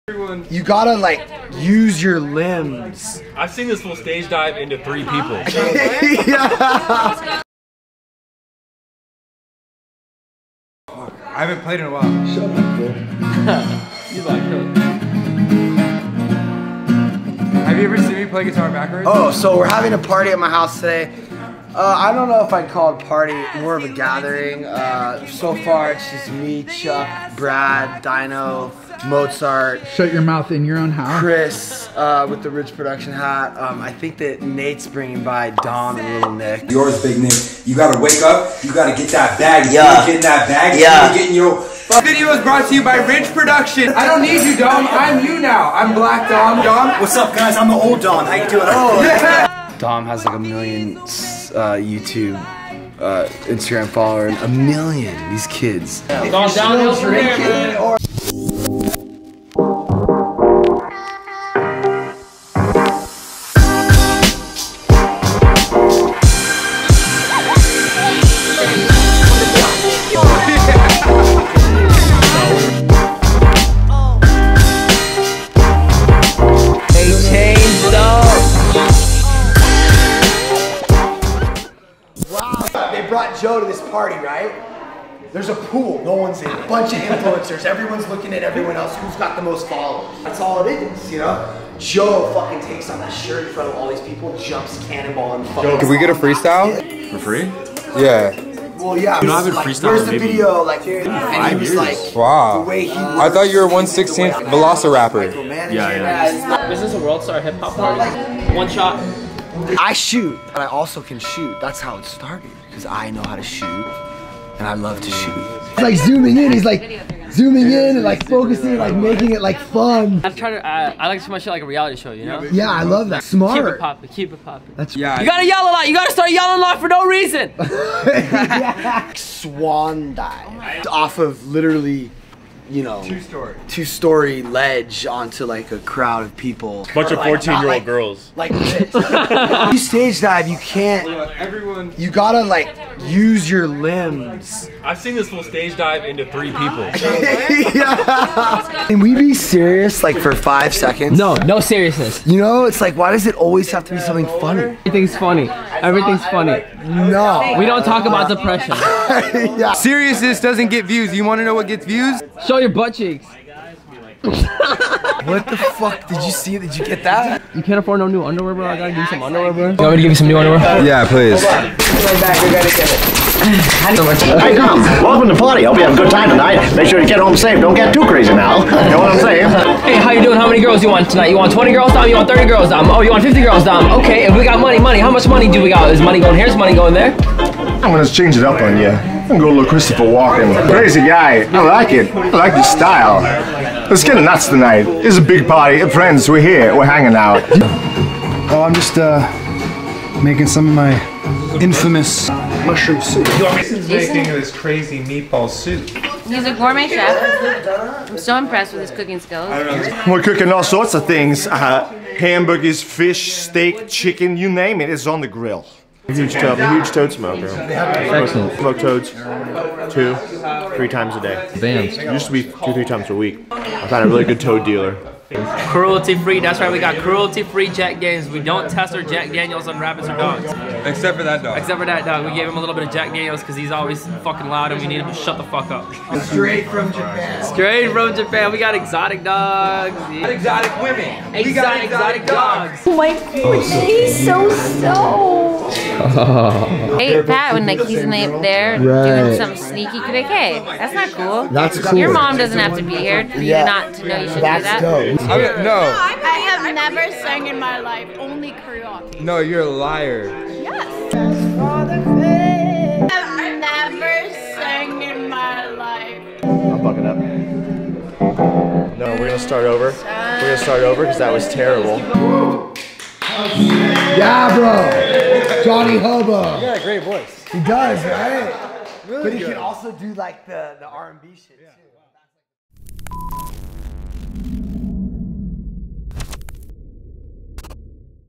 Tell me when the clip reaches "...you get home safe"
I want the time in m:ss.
2:57.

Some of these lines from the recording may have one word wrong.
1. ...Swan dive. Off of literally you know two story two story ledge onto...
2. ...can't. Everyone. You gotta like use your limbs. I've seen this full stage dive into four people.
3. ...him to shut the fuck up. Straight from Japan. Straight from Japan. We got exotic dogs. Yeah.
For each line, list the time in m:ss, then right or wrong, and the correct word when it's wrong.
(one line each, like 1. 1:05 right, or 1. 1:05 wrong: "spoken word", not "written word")
1. 2:09 right
2. 2:20 wrong: "three", not "four"
3. 3:55 right.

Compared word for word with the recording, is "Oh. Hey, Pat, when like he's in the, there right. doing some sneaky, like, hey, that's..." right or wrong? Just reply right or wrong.
right.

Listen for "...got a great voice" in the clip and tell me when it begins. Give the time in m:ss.
4:36.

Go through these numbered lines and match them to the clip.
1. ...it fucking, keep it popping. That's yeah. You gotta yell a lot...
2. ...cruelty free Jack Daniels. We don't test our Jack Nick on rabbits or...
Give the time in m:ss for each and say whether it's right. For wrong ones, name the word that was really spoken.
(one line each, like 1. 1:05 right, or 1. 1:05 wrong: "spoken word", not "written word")
1. 2:03 wrong: "popping", not "fucking"
2. 3:46 wrong: "Daniels", not "Nick".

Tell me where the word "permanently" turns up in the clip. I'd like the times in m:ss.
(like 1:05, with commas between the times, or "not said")
not said.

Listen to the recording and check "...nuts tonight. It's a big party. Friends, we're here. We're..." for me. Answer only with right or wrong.
right.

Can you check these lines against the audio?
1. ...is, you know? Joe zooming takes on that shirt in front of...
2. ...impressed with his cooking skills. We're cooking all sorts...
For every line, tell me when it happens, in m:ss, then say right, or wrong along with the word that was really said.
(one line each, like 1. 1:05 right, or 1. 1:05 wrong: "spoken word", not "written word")
1. 1:30 wrong: "fucking", not "zooming"
2. 3:28 right.